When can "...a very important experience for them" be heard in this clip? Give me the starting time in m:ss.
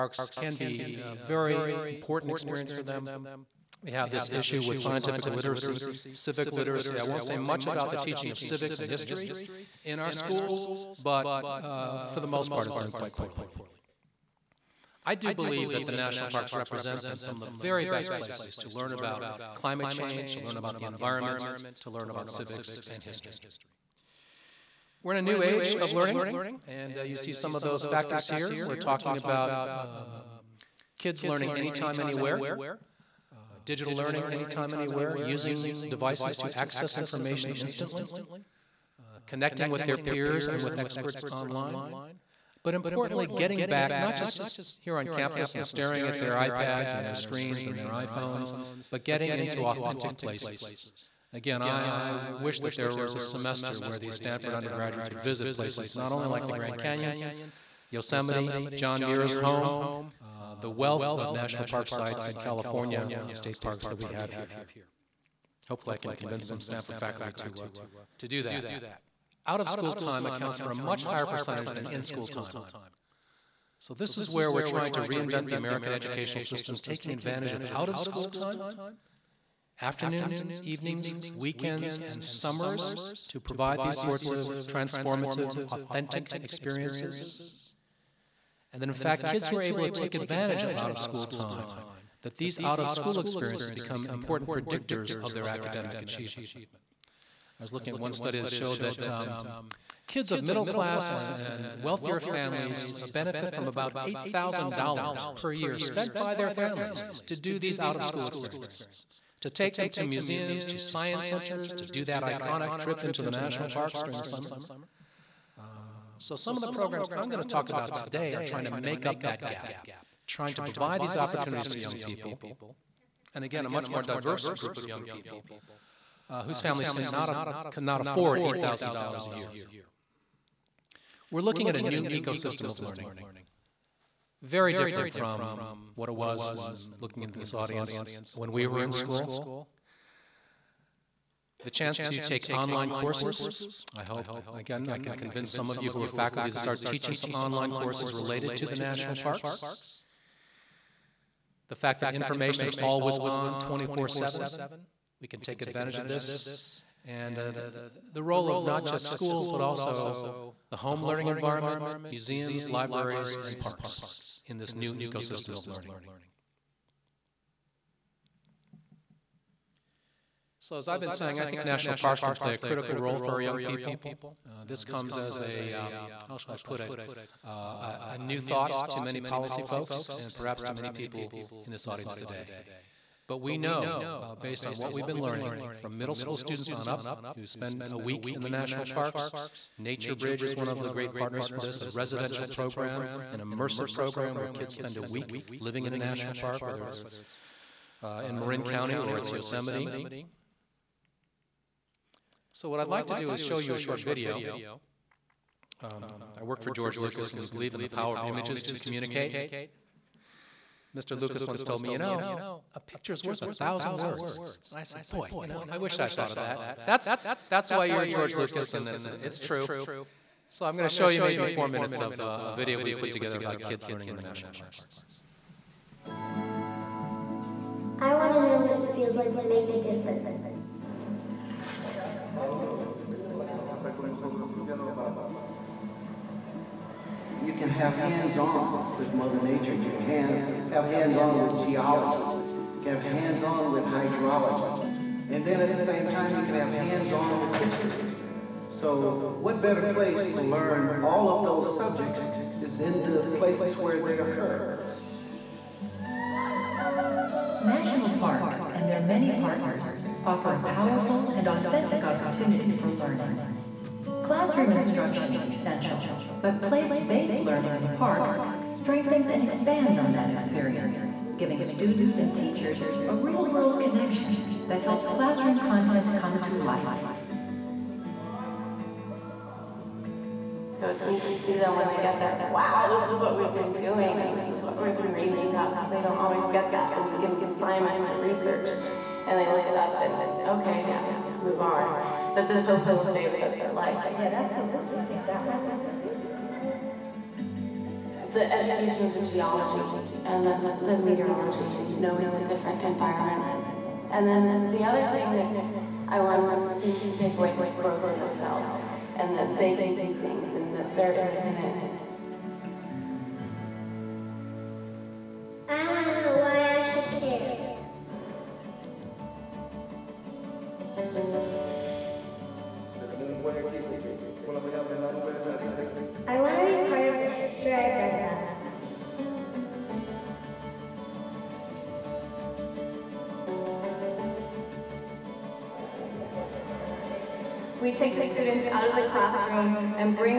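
0:01.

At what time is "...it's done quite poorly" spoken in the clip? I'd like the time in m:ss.
0:12.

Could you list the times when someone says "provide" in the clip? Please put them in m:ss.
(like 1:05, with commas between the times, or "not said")
1:23, 2:00.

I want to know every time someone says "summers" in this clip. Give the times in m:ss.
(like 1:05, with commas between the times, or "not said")
1:22, 1:54.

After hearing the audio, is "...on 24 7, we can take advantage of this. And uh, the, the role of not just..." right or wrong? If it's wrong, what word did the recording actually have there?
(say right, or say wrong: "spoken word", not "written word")
right.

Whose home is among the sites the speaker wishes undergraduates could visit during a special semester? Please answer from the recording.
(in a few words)
John Muir.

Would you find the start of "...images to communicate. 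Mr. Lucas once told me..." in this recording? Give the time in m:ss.
3:28.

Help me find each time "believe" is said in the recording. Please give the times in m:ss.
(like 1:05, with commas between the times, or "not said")
0:15, 3:27.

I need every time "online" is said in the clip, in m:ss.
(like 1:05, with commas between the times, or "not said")
0:41, 2:22, 2:27.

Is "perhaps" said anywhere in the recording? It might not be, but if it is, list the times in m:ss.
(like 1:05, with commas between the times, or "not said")
3:00.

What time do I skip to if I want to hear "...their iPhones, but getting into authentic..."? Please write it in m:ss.
0:47.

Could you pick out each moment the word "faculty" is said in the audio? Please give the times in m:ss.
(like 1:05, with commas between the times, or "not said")
1:06, 2:26.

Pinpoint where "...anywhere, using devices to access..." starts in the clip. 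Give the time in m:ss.
0:34.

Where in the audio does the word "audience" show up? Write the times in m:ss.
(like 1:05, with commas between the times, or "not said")
2:17, 3:01.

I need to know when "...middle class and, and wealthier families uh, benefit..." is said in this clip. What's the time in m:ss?
1:40.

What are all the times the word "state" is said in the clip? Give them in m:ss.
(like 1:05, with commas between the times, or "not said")
1:03.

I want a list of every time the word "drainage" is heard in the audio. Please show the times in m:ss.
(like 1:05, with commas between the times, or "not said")
not said.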